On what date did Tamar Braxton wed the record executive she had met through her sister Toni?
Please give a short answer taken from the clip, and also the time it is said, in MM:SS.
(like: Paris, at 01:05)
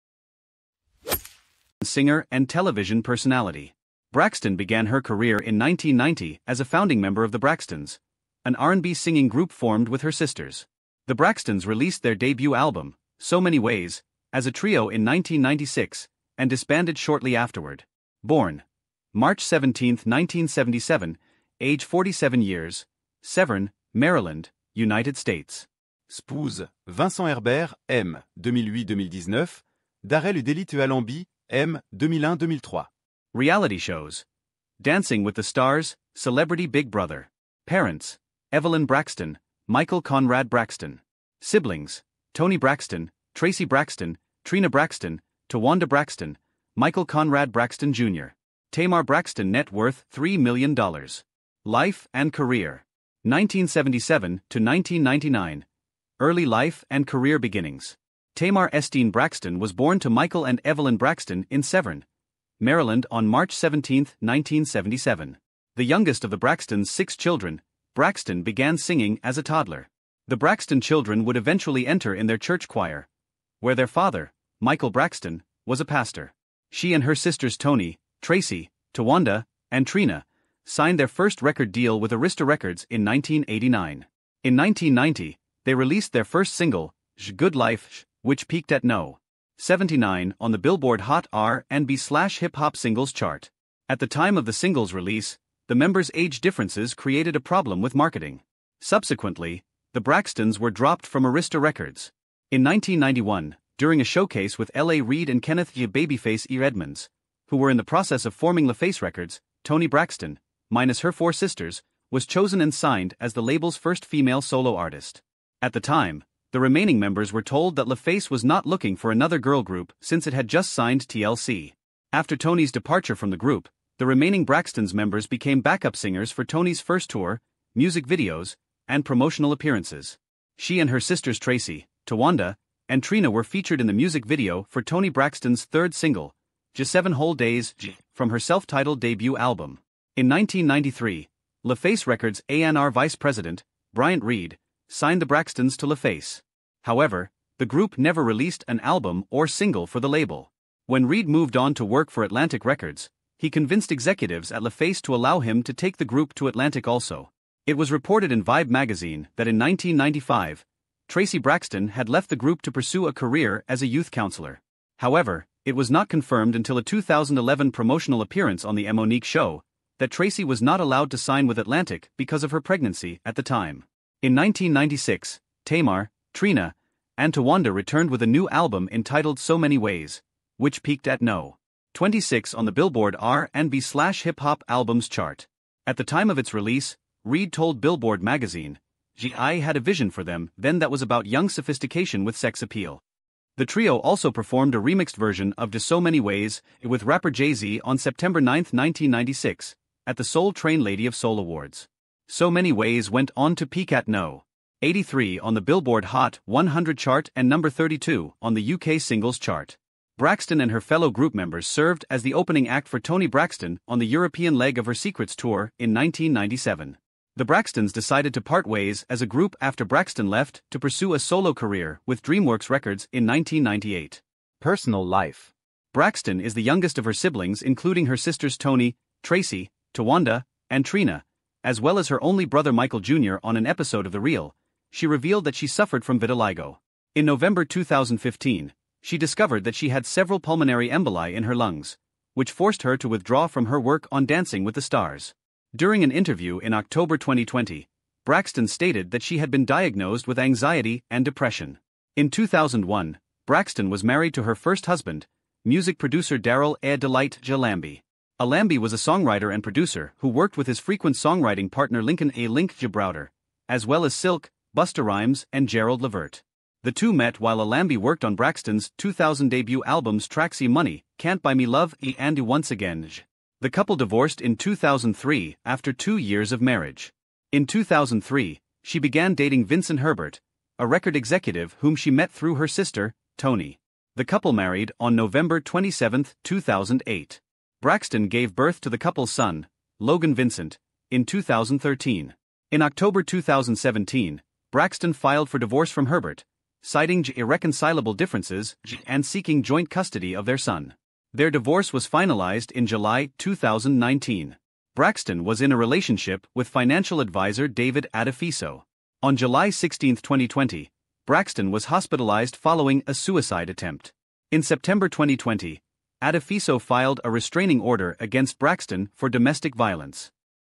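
November 27, 2008, at 04:45.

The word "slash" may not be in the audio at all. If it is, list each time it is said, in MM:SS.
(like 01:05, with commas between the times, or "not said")
01:31, 03:03.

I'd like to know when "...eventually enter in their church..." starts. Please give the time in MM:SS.
01:11.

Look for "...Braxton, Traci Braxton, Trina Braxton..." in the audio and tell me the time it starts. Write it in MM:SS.
00:42.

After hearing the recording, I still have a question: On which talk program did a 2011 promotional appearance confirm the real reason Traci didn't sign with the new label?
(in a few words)
The Mo'Nique Show.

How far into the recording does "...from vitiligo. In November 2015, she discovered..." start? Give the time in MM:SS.
03:56.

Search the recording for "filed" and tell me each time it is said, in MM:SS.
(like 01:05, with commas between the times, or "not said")
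04:55, 05:16.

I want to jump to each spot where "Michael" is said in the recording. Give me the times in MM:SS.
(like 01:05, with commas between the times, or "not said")
00:39, 00:46, 01:00, 01:14, 03:52.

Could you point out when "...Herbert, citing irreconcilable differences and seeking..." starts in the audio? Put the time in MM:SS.
04:56.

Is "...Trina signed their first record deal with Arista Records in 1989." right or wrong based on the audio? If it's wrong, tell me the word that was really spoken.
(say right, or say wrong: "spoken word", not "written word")
right.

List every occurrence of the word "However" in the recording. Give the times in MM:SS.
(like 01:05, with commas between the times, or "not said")
02:26, 02:44.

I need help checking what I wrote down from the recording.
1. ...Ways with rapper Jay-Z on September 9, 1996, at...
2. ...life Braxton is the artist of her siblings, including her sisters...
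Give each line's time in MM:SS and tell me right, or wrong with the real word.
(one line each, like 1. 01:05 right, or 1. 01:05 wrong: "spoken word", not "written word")
1. 03:16 right
2. 03:45 wrong: "youngest", not "artist".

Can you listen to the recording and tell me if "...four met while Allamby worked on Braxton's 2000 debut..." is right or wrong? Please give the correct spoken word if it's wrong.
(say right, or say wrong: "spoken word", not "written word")
wrong: "two", not "four".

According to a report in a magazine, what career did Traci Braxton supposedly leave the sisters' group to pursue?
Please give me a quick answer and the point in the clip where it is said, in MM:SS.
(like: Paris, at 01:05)
Youth counselor, at 02:43.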